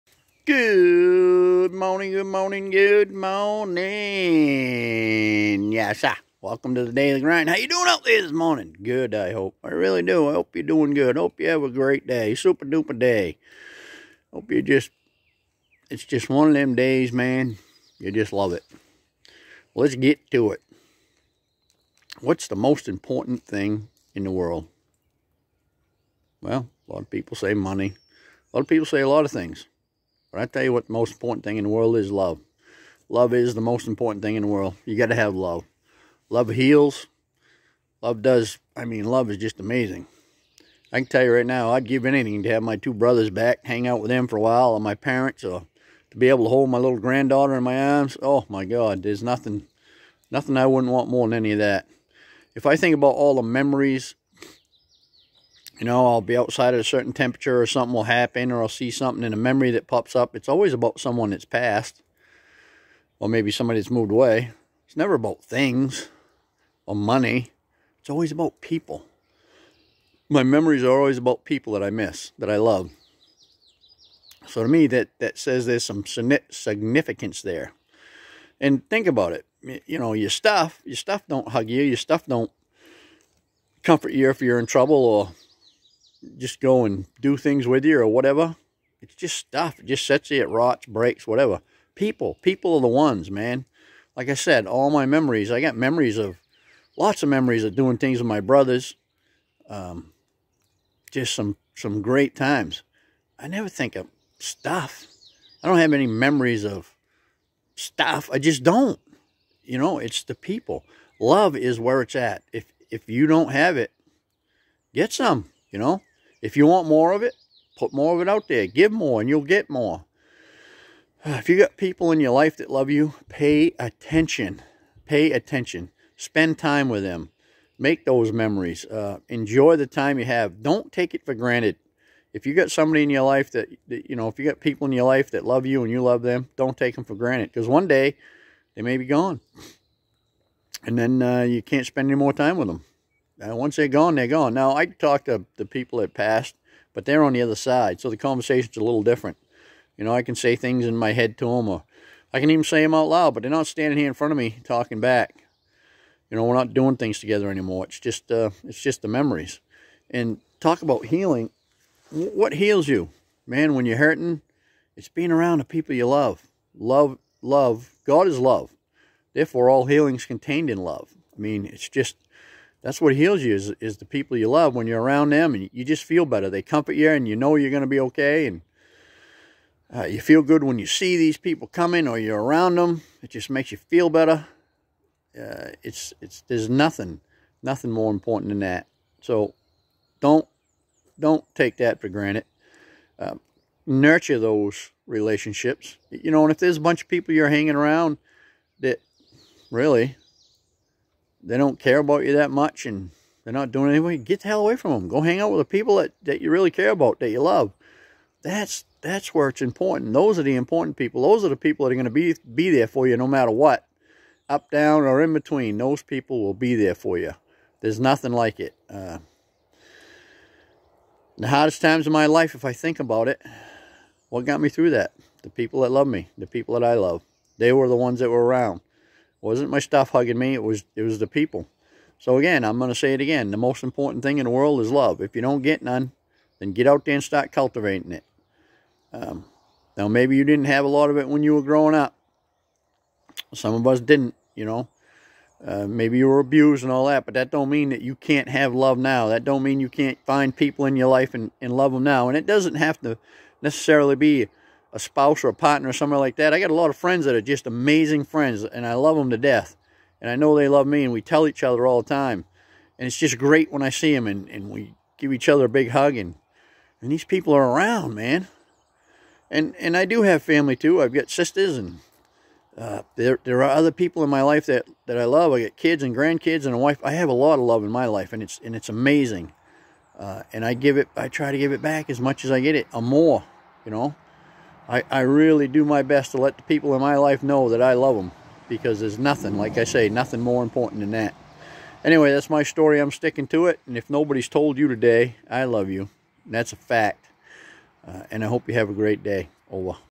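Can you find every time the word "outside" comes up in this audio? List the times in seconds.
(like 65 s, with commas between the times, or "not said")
56 s.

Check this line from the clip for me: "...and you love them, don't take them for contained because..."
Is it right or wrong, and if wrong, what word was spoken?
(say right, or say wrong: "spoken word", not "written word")
wrong: "granted", not "contained".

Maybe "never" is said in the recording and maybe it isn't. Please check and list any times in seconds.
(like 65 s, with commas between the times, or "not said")
64 s, 103 s.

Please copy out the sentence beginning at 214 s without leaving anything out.
Up, down, or in between, those people will be there for you.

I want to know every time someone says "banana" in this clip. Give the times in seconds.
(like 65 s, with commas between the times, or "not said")
not said.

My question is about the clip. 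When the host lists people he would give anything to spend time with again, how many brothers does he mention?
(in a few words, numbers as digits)
2.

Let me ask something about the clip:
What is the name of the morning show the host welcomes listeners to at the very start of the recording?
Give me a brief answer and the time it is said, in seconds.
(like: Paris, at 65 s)
Daily Grind, at 6 s.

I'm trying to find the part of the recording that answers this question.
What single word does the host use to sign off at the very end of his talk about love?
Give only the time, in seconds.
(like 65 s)
299 s.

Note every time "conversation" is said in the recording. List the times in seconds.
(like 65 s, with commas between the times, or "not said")
148 s.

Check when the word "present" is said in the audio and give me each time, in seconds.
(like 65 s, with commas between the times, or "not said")
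not said.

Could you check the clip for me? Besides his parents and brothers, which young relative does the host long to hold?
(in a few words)
granddaughter.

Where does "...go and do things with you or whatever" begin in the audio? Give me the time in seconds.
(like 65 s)
86 s.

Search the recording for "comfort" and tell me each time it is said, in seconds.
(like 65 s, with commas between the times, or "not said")
83 s, 176 s.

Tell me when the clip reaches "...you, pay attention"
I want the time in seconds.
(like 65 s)
122 s.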